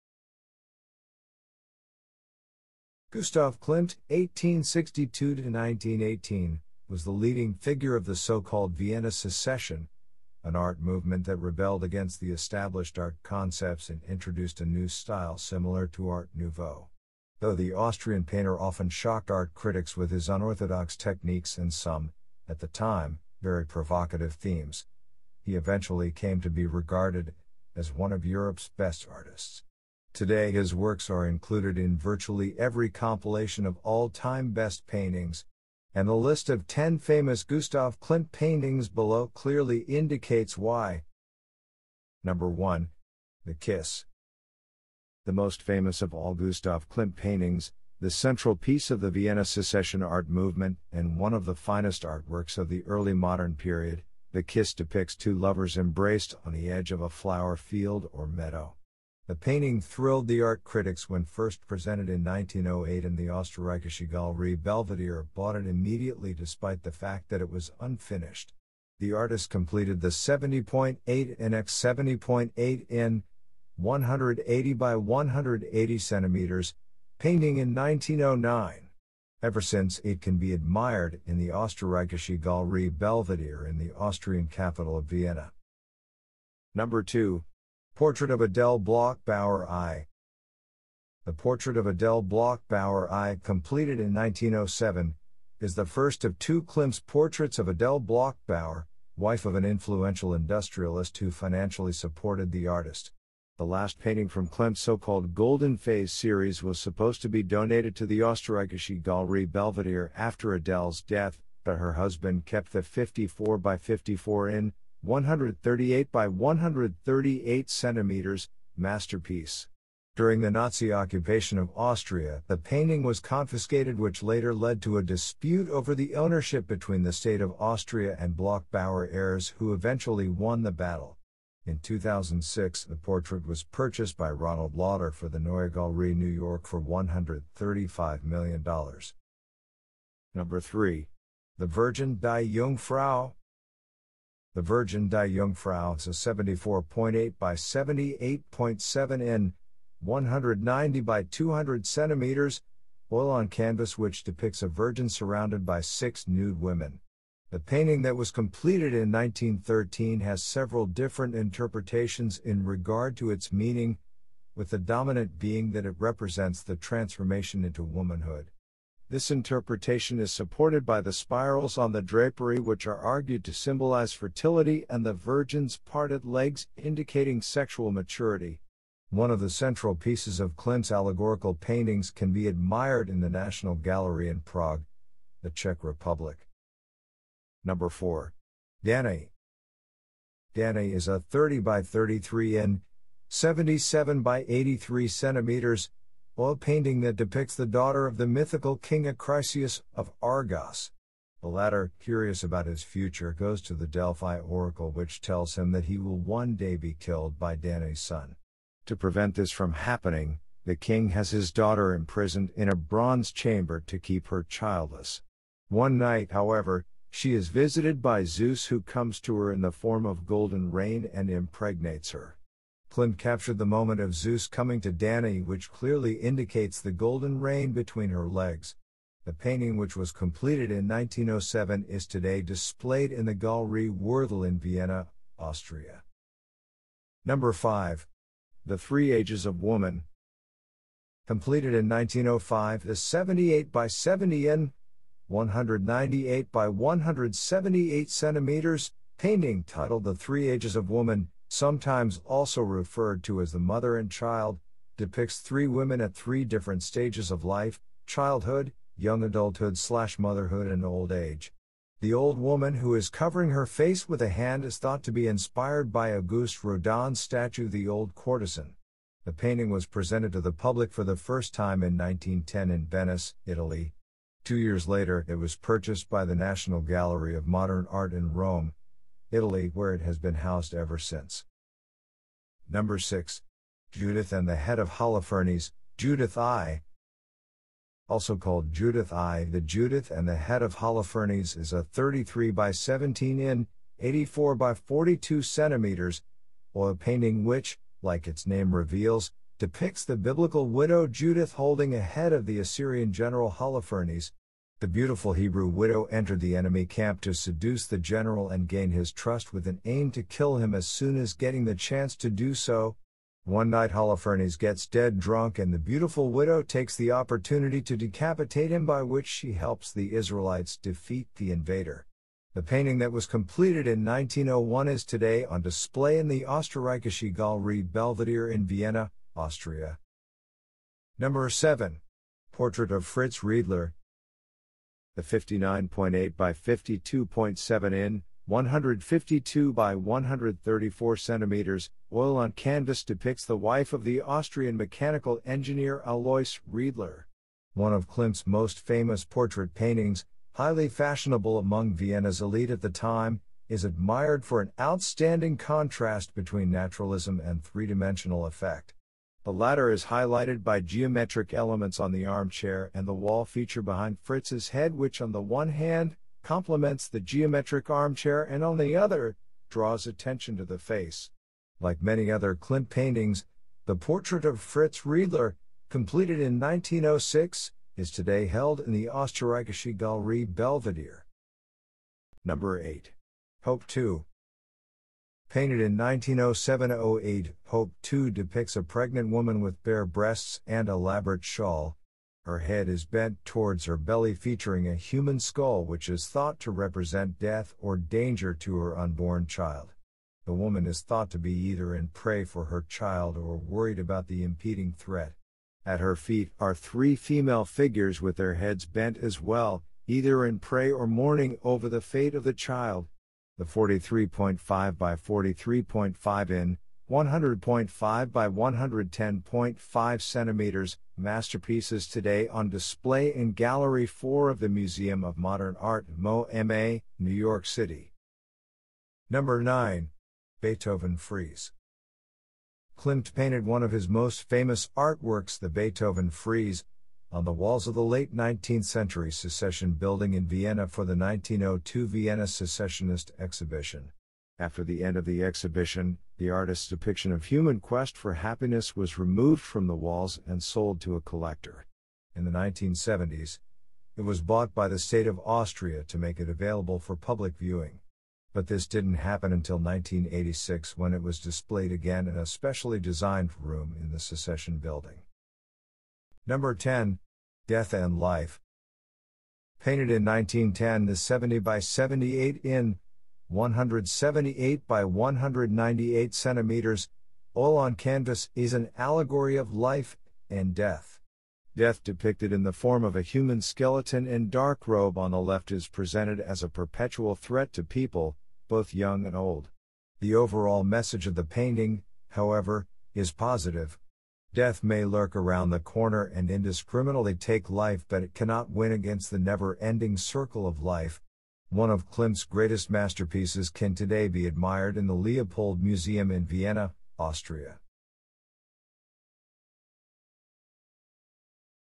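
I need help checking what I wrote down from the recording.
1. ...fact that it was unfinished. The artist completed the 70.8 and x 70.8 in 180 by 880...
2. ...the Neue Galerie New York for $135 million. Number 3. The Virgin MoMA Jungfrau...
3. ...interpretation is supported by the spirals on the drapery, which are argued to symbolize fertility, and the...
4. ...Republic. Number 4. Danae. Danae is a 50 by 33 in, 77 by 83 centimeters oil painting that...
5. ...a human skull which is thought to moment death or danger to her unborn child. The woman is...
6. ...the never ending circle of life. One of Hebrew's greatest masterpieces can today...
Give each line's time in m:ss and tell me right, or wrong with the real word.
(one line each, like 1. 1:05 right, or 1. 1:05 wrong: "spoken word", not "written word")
1. 1:06 wrong: "180", not "880"
2. 2:15 wrong: "Die", not "MoMA"
3. 2:49 right
4. 3:05 wrong: "30", not "50"
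5. 6:34 wrong: "represent", not "moment"
6. 8:19 wrong: "Klimt", not "Hebrew".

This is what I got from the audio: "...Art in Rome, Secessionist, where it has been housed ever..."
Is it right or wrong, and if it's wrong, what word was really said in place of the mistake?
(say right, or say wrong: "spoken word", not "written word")
wrong: "Italy", not "Secessionist".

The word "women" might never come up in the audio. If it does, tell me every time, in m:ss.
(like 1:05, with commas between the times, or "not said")
2:36, 4:15.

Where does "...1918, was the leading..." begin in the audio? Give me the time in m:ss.
0:05.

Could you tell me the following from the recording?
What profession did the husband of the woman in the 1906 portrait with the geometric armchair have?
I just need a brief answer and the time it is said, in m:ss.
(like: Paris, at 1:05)
Mechanical engineer, at 5:44.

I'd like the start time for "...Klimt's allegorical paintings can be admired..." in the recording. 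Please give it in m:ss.
3:00.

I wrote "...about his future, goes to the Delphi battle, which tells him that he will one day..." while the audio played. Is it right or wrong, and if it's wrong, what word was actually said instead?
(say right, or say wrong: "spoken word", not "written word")
wrong: "oracle", not "battle".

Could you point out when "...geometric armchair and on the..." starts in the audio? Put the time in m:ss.
6:07.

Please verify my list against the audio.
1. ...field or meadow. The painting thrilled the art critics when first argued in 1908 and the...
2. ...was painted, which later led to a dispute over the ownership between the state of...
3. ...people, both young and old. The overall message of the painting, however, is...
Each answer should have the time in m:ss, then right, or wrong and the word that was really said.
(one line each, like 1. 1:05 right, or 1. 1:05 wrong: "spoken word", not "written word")
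1. 0:57 wrong: "presented", not "argued"
2. 2:03 wrong: "confiscated", not "painted"
3. 8:07 right.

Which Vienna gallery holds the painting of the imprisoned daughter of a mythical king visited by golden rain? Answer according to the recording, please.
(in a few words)
Galerie Würthle.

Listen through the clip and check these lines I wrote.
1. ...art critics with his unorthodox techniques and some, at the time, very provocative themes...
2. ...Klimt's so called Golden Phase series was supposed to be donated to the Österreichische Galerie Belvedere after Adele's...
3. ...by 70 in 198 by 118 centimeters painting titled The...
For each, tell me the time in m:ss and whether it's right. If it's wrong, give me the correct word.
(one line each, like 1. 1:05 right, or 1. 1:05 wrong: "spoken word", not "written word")
1. 0:19 right
2. 1:44 right
3. 4:03 wrong: "178", not "118".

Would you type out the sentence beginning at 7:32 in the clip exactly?
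In the 1970s, it was bought by the state of Austria to make it available for public viewing.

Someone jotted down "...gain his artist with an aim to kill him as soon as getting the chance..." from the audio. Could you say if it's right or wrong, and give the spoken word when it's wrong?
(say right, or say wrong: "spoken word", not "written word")
wrong: "trust", not "artist".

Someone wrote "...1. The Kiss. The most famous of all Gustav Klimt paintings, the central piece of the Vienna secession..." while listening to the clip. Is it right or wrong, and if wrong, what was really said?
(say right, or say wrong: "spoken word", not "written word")
right.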